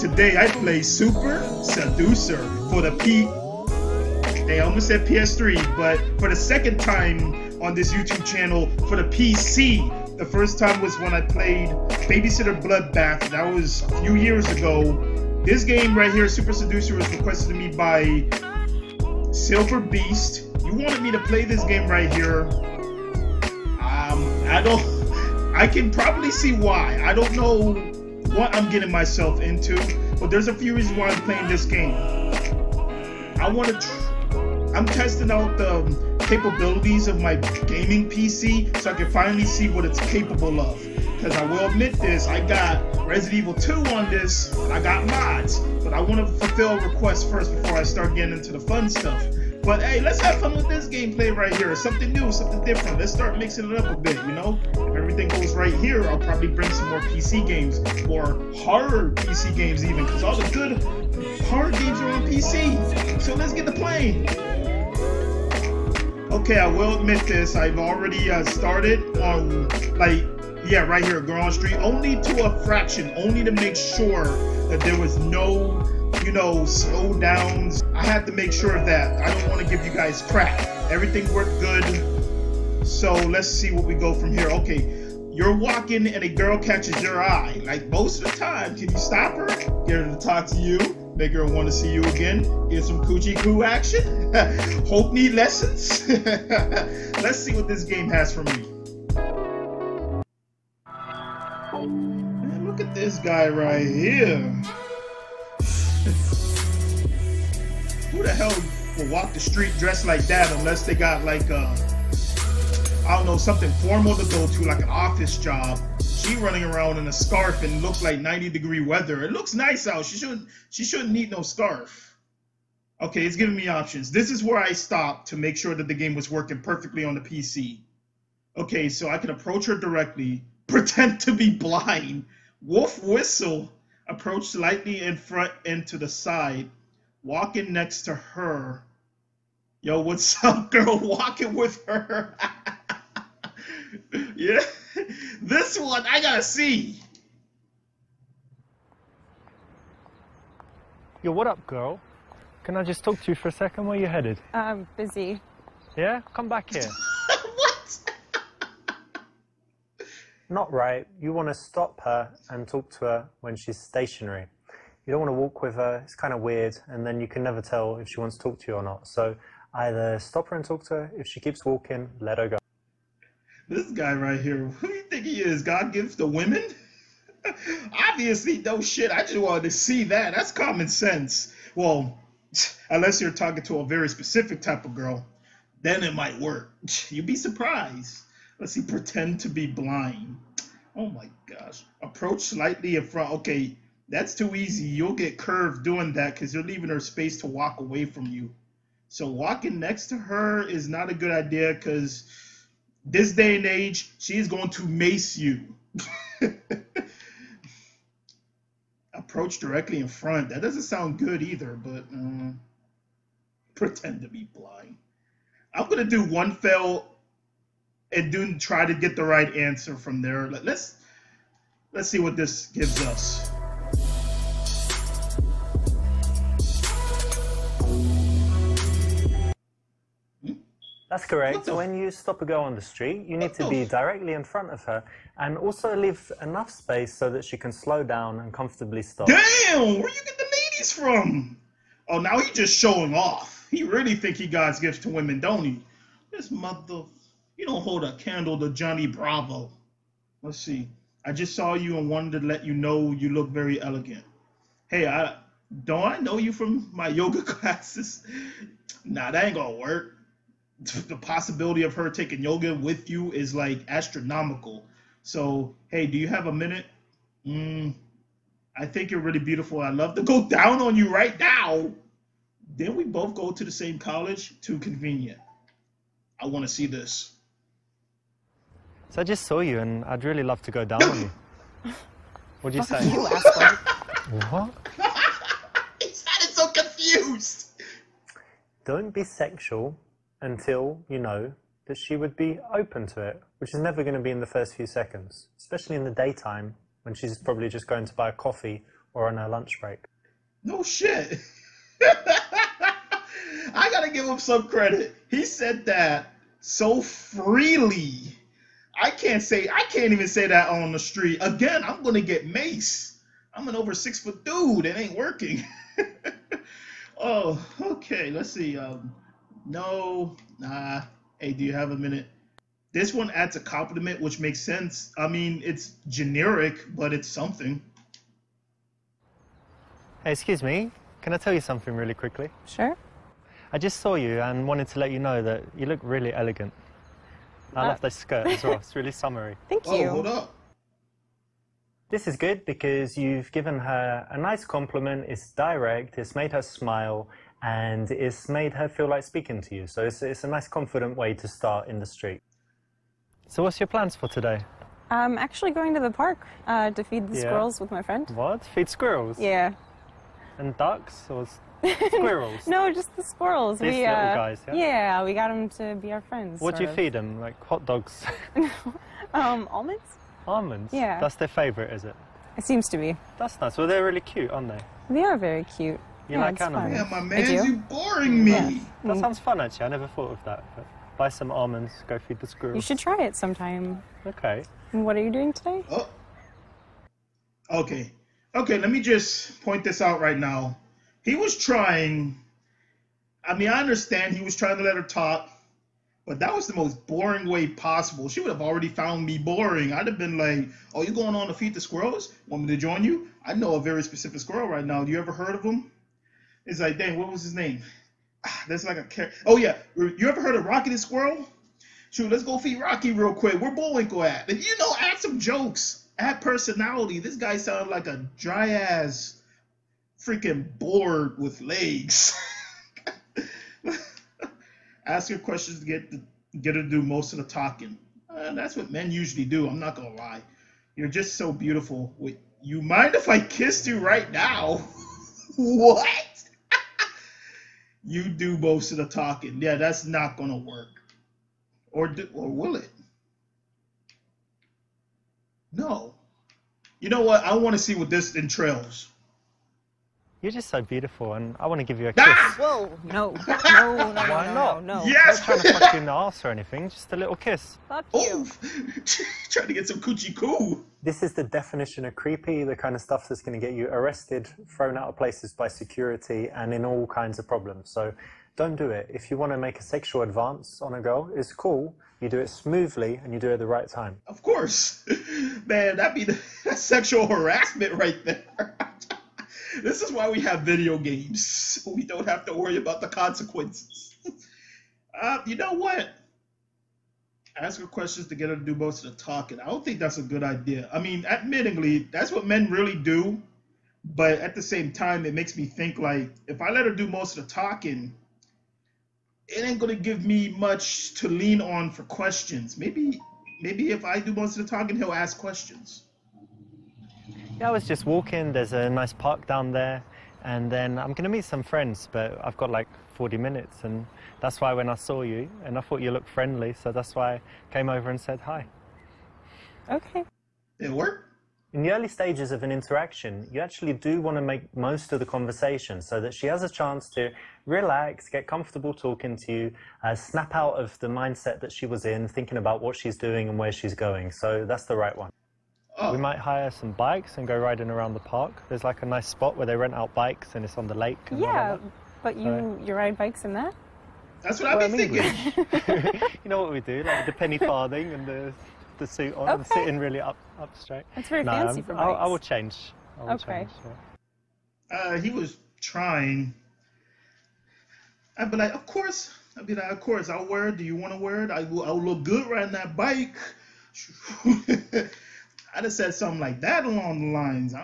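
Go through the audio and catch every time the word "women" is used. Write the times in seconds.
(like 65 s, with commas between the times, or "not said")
176 s, 245 s.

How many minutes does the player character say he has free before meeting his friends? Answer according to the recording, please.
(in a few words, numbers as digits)
40.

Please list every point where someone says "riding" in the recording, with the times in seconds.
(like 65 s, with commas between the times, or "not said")
537 s, 562 s.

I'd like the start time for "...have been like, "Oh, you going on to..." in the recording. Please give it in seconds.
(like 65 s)
400 s.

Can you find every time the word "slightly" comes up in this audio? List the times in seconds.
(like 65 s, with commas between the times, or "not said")
134 s, 192 s.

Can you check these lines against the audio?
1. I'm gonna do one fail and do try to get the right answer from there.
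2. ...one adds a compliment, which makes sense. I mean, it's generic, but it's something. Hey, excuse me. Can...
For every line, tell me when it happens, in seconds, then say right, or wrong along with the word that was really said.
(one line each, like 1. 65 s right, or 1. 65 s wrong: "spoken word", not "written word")
1. 215 s right
2. 323 s right.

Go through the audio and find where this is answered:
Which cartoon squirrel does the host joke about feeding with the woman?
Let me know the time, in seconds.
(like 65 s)
410 s.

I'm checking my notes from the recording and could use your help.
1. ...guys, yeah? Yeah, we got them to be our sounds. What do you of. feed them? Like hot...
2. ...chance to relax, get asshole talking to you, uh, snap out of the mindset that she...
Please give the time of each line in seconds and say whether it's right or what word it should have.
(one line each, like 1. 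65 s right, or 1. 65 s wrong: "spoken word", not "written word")
1. 364 s wrong: "friends", not "sounds"
2. 526 s wrong: "comfortable", not "asshole".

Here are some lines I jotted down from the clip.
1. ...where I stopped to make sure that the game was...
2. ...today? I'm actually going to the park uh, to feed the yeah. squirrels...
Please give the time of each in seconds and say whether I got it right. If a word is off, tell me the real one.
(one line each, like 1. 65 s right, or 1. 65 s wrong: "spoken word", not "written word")
1. 124 s right
2. 354 s right.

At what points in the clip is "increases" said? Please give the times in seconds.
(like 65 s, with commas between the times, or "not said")
not said.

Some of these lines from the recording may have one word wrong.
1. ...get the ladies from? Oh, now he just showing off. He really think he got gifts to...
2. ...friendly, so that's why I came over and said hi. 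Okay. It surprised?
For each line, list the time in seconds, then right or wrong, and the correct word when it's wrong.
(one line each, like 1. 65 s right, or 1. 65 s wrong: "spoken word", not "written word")
1. 240 s right
2. 516 s wrong: "worked", not "surprised".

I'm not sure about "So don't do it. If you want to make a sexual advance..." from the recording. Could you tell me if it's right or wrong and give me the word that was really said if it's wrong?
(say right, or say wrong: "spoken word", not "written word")
right.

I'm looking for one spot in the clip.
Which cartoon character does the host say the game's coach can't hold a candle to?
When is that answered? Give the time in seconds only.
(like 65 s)
248 s.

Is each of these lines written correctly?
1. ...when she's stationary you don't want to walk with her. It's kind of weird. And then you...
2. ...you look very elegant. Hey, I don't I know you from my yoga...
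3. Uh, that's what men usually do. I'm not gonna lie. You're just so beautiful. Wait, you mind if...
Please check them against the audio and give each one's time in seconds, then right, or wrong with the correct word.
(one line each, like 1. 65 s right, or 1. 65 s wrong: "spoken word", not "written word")
1. 163 s right
2. 253 s right
3. 428 s right.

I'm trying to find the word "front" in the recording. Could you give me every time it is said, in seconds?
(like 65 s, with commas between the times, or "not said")
135 s, 193 s, 210 s, 234 s.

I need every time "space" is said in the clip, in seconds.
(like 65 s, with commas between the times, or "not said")
196 s, 236 s.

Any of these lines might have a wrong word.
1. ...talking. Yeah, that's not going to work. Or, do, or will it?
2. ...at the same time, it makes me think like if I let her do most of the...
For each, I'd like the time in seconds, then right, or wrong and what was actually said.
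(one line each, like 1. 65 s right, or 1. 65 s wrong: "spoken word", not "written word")
1. 439 s right
2. 494 s right.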